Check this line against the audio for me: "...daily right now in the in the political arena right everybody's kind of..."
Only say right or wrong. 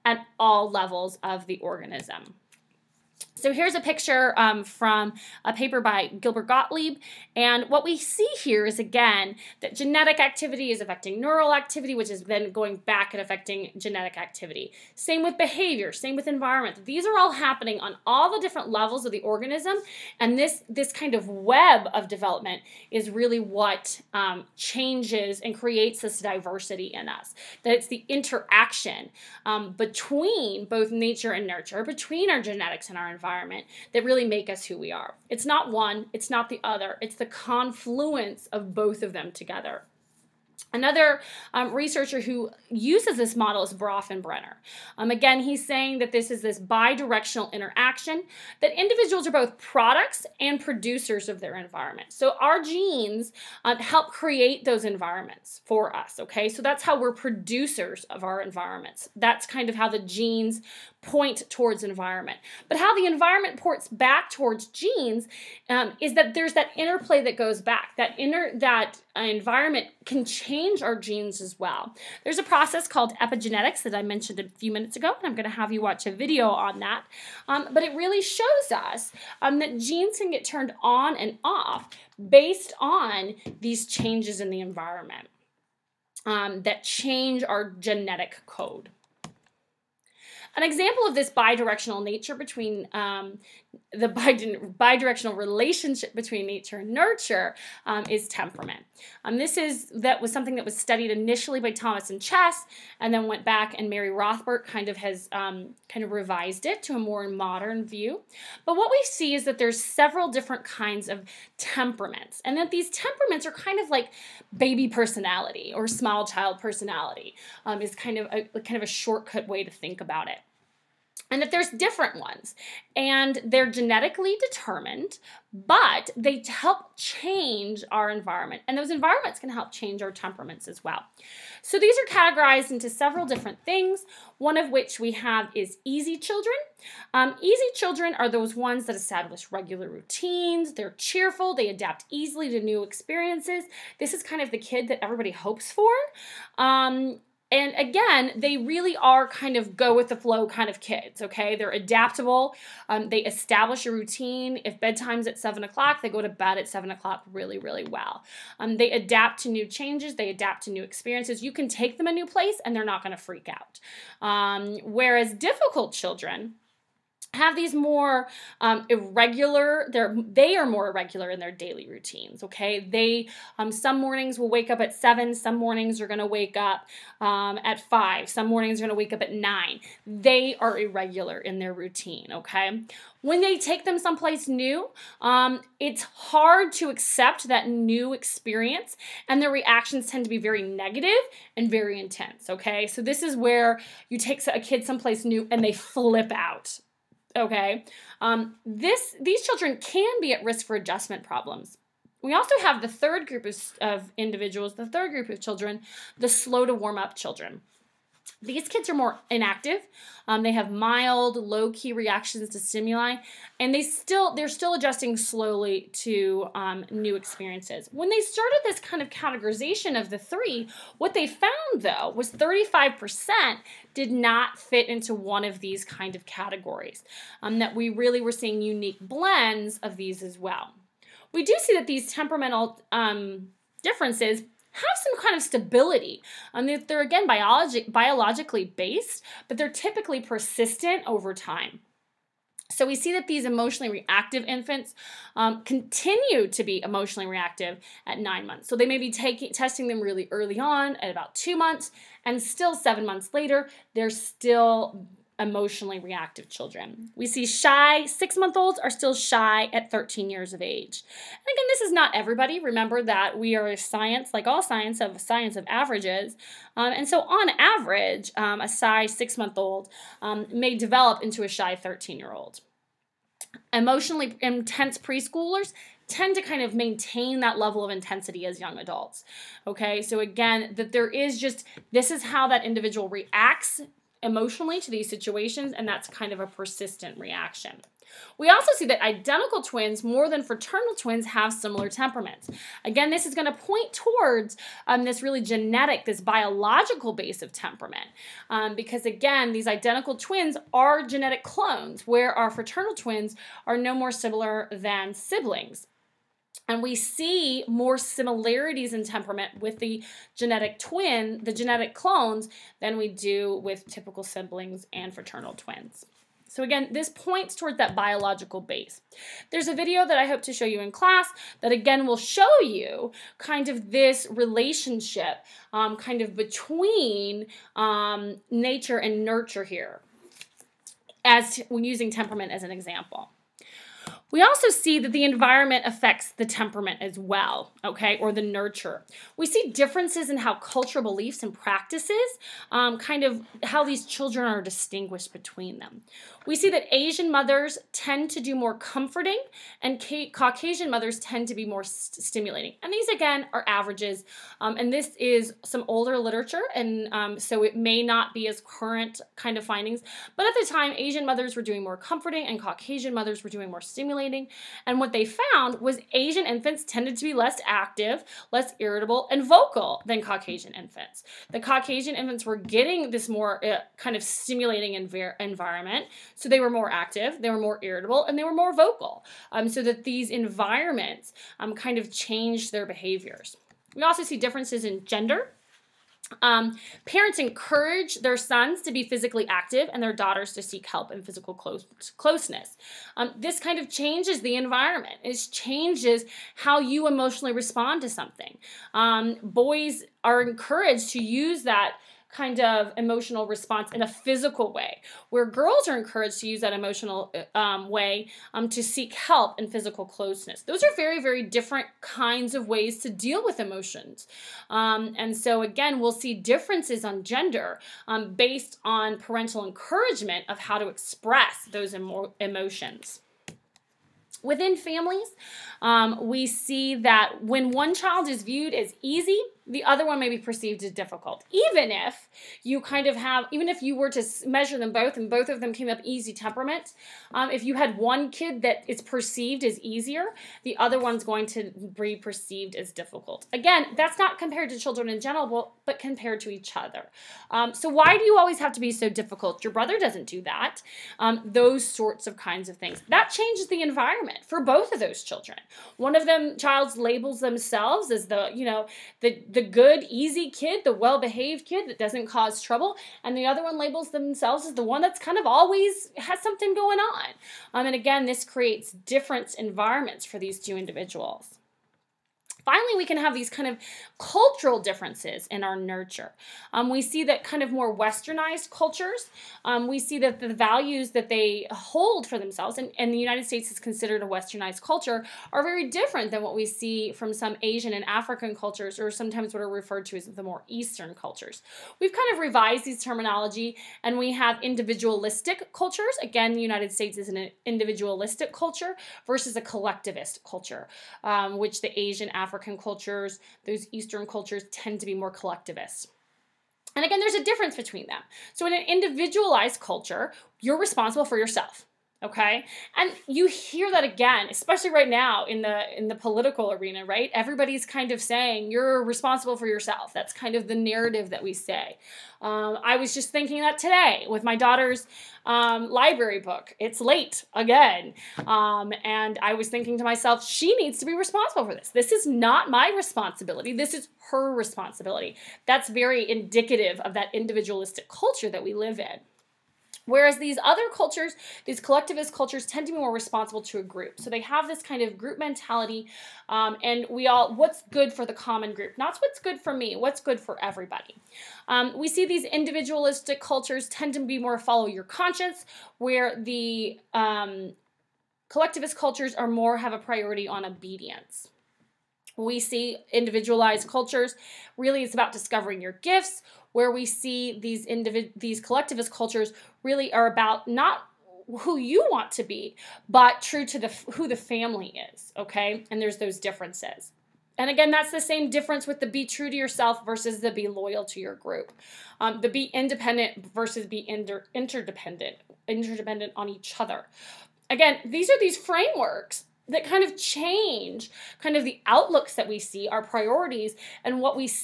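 wrong.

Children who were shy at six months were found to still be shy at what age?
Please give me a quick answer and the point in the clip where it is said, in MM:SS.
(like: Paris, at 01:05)
13, at 04:19.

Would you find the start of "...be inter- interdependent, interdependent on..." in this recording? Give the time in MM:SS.
09:43.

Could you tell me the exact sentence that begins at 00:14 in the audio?
Same with behavior, same with environment.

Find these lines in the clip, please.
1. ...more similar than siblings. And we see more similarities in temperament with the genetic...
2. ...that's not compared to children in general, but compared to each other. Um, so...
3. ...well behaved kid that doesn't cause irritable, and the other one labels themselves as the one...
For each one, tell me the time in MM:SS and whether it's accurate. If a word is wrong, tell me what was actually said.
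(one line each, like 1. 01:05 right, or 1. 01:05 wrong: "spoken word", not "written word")
1. 05:03 right
2. 07:23 right
3. 07:40 wrong: "trouble", not "irritable".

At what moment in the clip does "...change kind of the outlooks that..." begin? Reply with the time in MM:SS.
09:50.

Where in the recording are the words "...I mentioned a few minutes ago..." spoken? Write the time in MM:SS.
01:13.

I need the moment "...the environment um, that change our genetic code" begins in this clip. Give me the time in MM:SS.
01:24.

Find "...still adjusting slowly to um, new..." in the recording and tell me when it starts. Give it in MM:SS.
03:34.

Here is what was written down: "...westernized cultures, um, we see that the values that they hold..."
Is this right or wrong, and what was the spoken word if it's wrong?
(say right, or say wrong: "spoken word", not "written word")
right.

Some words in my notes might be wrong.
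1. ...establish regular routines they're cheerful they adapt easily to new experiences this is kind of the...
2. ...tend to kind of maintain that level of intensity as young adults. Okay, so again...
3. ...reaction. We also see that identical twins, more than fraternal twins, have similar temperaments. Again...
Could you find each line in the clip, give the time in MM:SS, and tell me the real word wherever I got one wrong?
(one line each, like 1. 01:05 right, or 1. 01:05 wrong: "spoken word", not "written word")
1. 02:18 right
2. 04:36 right
3. 04:47 right.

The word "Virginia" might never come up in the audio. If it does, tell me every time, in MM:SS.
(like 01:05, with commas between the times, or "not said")
not said.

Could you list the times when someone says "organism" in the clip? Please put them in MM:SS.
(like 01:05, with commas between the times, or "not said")
00:01, 00:19.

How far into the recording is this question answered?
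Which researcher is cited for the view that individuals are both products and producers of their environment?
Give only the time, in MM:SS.
00:43.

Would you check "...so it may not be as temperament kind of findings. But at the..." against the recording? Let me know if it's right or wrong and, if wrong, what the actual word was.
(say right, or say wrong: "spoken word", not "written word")
wrong: "current", not "temperament".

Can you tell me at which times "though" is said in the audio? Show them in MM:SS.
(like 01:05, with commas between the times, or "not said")
03:41.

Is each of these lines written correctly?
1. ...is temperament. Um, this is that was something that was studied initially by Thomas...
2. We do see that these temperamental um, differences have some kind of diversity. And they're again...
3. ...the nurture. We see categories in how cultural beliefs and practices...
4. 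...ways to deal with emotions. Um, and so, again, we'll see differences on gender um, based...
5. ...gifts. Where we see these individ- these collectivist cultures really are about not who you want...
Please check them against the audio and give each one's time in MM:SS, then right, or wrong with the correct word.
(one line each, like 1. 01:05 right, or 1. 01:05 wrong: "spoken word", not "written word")
1. 01:38 right
2. 03:51 wrong: "stability", not "diversity"
3. 05:38 wrong: "differences", not "categories"
4. 06:52 right
5. 09:25 right.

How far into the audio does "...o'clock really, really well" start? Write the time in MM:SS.
02:36.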